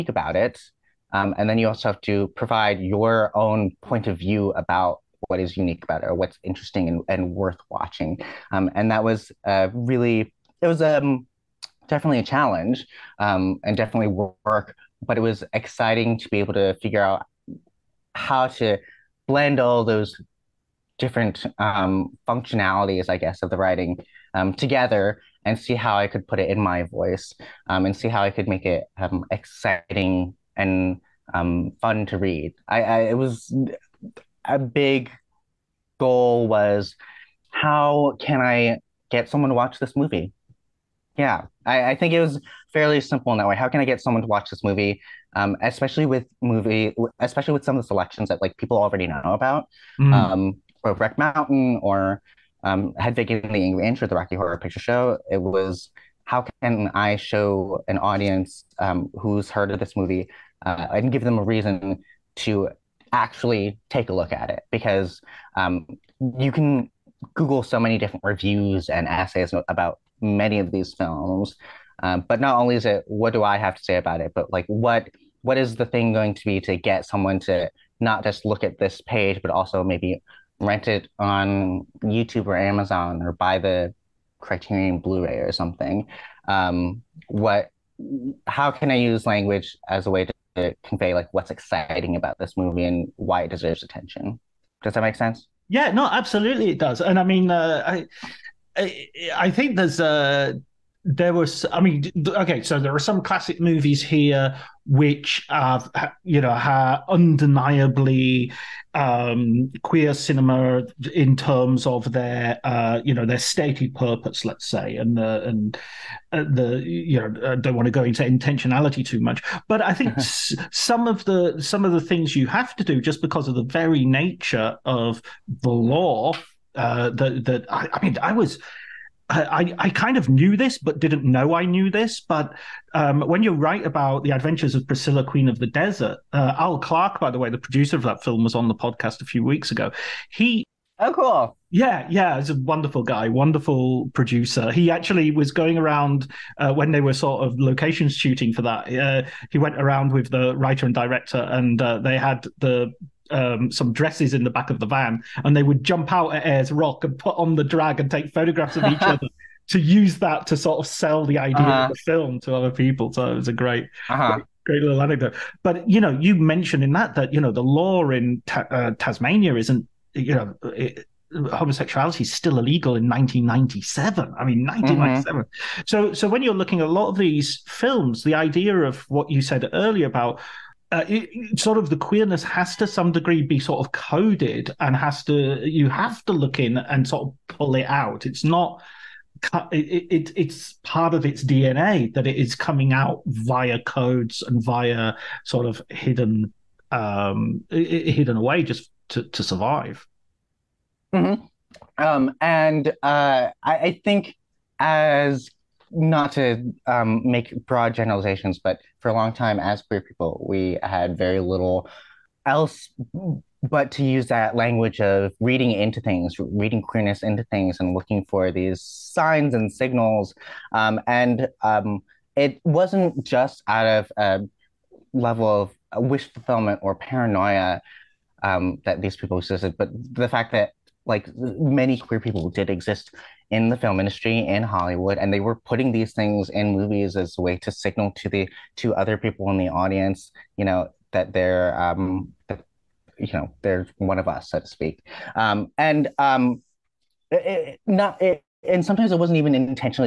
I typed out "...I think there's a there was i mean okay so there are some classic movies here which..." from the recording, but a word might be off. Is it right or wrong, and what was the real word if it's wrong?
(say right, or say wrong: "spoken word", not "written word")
right.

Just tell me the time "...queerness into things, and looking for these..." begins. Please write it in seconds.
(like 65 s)
216 s.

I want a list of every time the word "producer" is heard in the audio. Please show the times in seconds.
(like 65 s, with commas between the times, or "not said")
137 s, 144 s.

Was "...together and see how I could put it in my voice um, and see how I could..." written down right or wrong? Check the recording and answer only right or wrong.
right.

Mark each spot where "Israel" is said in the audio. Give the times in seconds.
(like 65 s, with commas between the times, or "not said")
not said.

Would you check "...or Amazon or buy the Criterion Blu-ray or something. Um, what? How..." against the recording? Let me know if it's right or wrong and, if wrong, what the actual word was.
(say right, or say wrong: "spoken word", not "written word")
right.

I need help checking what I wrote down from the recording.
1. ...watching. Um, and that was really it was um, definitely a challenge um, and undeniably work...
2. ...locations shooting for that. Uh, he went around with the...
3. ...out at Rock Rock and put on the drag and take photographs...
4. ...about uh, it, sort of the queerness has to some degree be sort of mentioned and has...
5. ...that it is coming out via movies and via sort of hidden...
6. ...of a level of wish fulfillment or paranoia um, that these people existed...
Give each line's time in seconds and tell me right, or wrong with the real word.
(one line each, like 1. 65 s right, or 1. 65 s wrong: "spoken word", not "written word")
1. 7 s wrong: "definitely", not "undeniably"
2. 147 s right
3. 156 s wrong: "Ayers", not "Rock"
4. 180 s wrong: "coded", not "mentioned"
5. 192 s wrong: "codes", not "movies"
6. 223 s right.